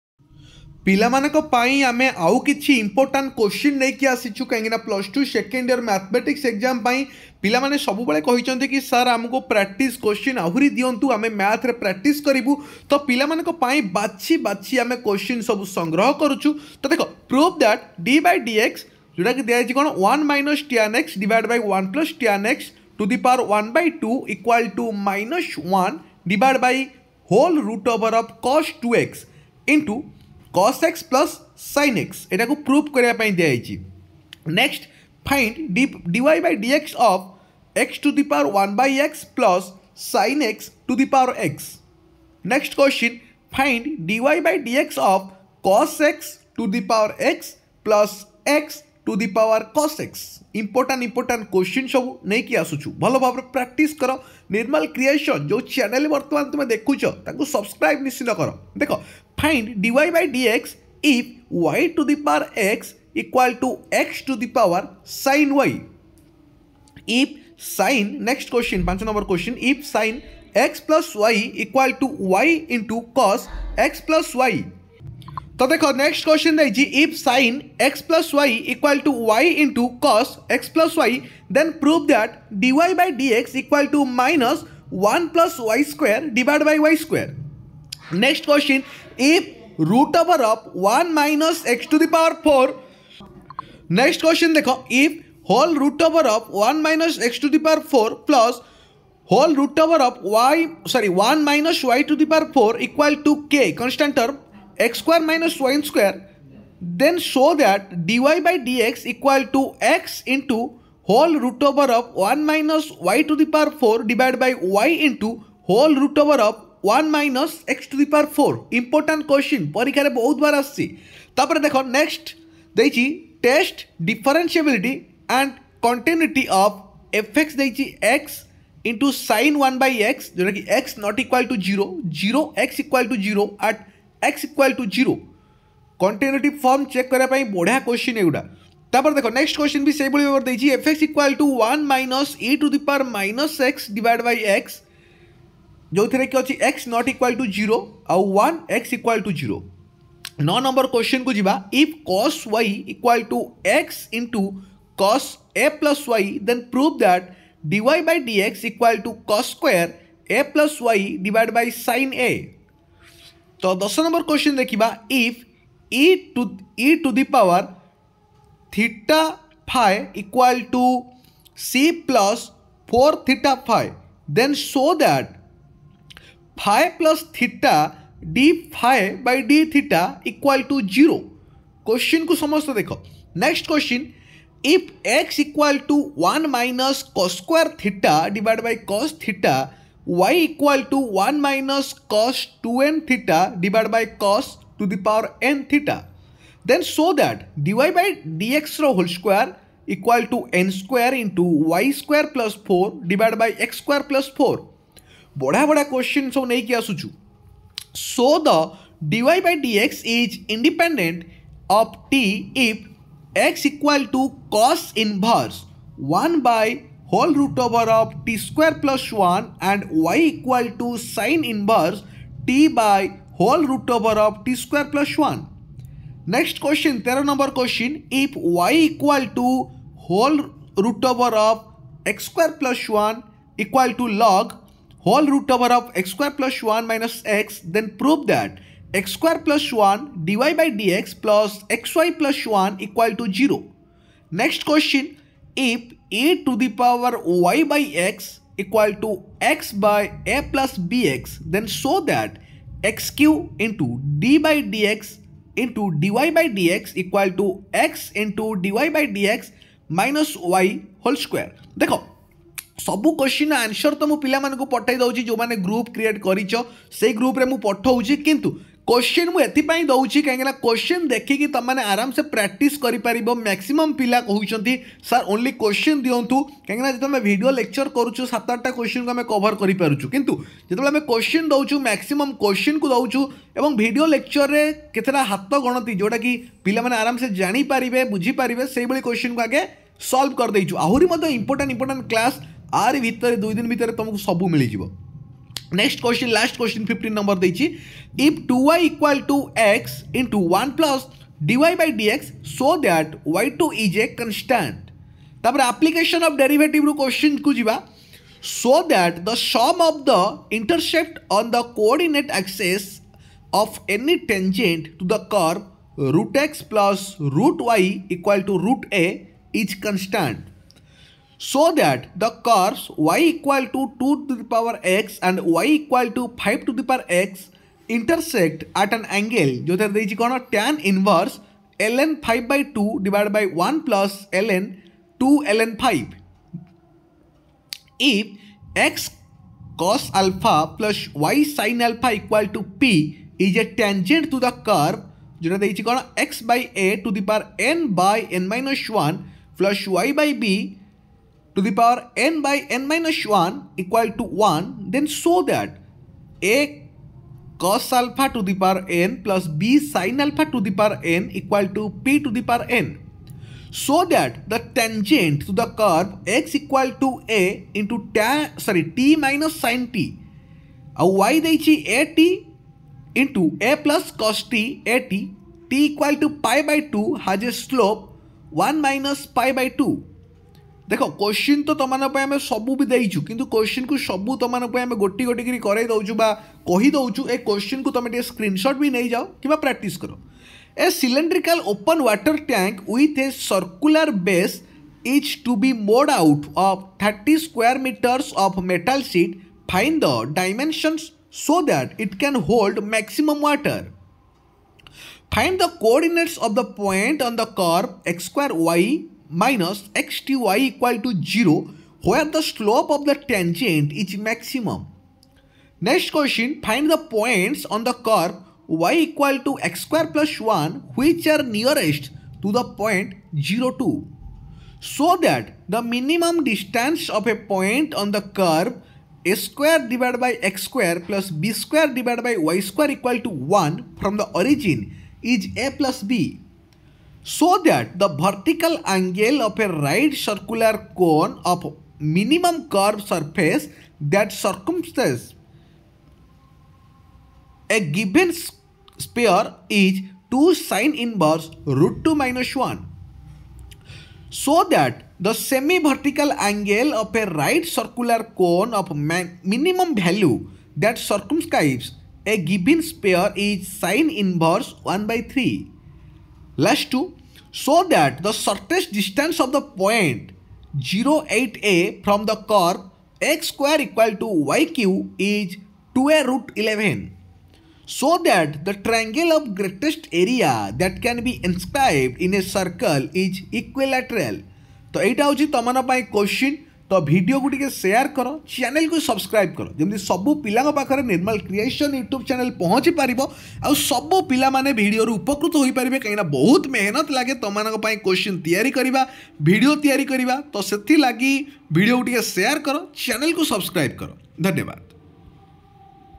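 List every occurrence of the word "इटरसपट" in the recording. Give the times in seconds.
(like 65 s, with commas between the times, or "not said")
310 s.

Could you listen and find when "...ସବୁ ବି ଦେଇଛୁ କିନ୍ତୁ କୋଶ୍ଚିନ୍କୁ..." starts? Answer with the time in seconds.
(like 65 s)
382 s.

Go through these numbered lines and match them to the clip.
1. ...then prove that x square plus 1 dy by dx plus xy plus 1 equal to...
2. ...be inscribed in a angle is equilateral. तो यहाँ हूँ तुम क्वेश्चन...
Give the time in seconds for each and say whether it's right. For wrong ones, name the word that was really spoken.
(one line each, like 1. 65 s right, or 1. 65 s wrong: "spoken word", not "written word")
1. 237 s right
2. 481 s wrong: "circle", not "angle".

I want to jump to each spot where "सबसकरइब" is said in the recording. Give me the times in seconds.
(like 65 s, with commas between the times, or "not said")
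57 s, 488 s, 503 s.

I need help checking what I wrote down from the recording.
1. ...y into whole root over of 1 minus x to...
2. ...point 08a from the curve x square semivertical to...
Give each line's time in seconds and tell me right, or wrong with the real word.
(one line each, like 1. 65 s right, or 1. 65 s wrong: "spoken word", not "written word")
1. 114 s right
2. 469 s wrong: "equal", not "semivertical".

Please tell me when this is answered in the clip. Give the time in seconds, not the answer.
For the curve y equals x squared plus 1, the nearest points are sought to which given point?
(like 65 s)
423 s.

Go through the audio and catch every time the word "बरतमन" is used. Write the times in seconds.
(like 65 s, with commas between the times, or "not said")
56 s.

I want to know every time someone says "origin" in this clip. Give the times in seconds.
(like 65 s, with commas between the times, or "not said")
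434 s.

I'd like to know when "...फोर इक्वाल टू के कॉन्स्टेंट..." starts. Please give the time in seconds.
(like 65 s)
102 s.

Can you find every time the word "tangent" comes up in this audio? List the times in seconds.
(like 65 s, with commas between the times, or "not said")
343 s, 364 s, 413 s.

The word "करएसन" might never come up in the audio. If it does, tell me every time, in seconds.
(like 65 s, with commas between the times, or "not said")
54 s, 491 s.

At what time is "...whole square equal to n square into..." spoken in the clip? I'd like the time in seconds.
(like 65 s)
198 s.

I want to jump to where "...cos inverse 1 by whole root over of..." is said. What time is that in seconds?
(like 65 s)
214 s.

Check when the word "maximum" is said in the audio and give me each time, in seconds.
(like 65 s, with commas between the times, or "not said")
402 s, 414 s.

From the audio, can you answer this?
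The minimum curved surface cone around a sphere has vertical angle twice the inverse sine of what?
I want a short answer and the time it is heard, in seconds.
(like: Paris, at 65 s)
root 2 minus 1, at 451 s.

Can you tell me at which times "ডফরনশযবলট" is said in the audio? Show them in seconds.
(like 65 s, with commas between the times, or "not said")
124 s.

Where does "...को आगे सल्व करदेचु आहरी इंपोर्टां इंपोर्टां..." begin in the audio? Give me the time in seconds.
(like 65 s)
289 s.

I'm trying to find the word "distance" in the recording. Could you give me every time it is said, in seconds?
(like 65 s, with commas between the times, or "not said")
426 s, 468 s.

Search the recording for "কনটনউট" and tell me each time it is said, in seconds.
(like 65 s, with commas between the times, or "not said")
125 s.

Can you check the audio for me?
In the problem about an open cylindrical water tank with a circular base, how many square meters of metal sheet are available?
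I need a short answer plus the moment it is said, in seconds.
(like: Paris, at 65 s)
30, at 397 s.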